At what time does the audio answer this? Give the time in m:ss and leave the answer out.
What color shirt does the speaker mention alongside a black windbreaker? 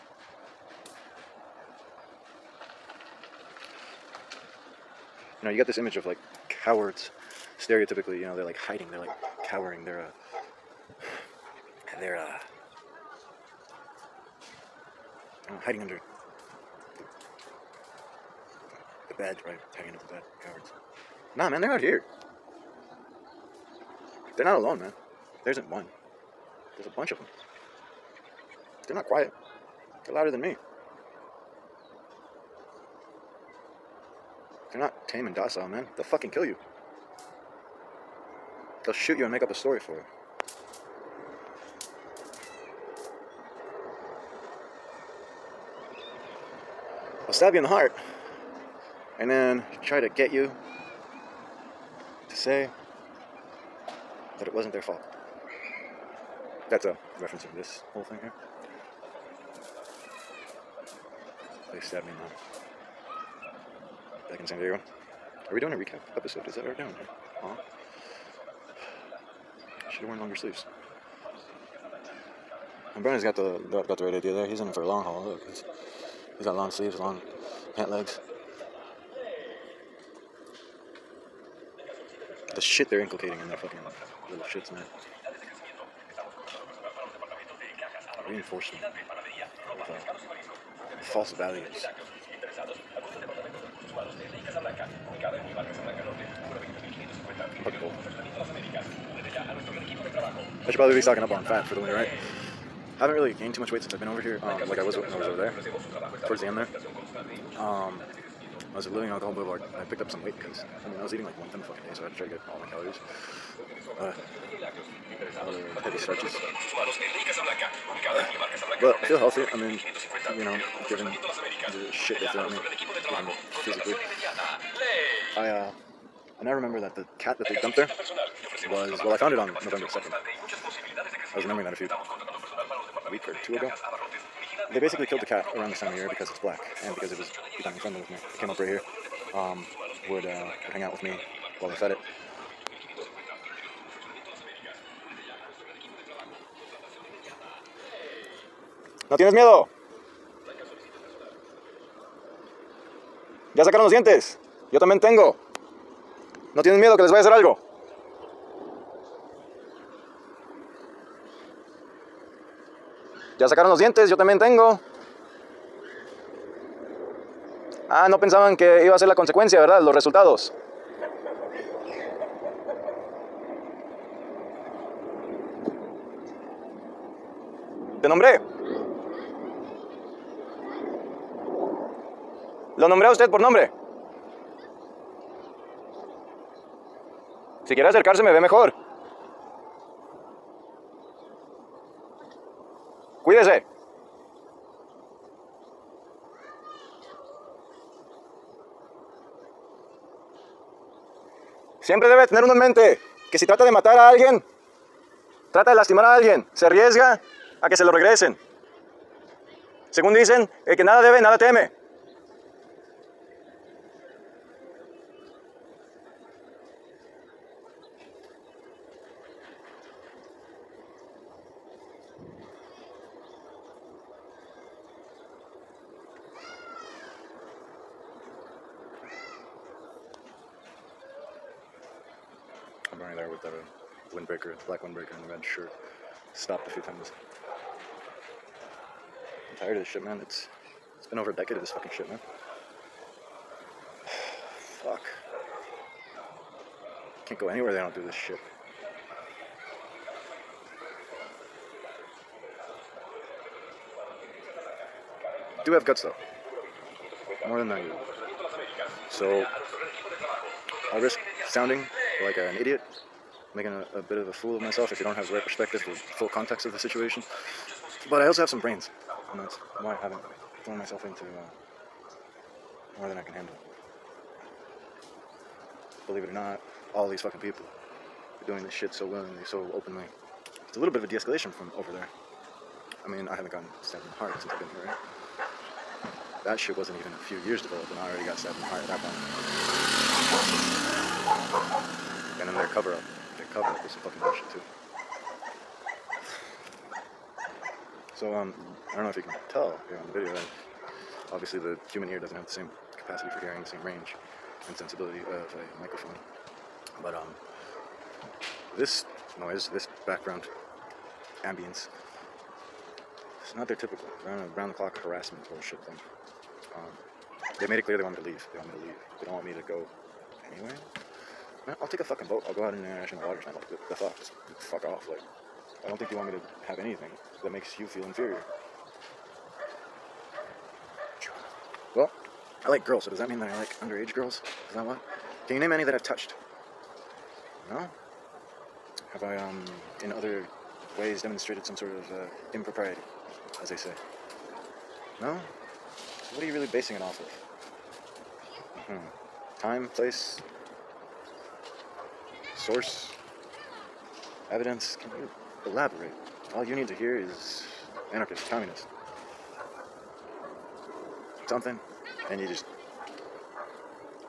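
3:55.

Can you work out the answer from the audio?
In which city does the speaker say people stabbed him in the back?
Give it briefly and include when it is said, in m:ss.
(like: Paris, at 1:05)
San Diego, at 1:04.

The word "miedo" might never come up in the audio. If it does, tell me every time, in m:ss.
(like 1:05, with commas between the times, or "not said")
2:29, 2:36.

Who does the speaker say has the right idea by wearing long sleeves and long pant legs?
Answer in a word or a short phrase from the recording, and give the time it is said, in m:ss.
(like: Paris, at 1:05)
Brennan, at 1:13.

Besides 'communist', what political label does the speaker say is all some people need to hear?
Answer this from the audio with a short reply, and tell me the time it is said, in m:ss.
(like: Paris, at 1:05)
anarchist, at 5:58.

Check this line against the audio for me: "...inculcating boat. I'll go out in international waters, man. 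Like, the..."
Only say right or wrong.
wrong.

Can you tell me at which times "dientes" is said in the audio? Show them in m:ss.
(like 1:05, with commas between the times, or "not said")
2:33, 2:43.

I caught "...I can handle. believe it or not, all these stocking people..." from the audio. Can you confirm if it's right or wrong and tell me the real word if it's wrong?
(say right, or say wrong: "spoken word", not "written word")
wrong: "fucking", not "stocking".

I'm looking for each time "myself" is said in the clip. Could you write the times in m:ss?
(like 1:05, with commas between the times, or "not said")
4:24, 4:30.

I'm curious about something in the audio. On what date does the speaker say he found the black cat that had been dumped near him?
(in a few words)
November 2.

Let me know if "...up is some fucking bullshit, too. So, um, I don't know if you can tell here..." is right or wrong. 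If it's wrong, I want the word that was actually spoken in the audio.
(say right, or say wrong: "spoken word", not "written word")
right.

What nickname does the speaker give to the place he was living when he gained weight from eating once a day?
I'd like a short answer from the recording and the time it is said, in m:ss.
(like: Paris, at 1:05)
Alcohol Boulevard, at 1:49.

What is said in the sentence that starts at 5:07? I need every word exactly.
But, um, this noise, this background ambience, it's not their typical round the clock harassment bullshit thing.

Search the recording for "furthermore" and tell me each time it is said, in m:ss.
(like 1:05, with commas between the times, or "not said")
not said.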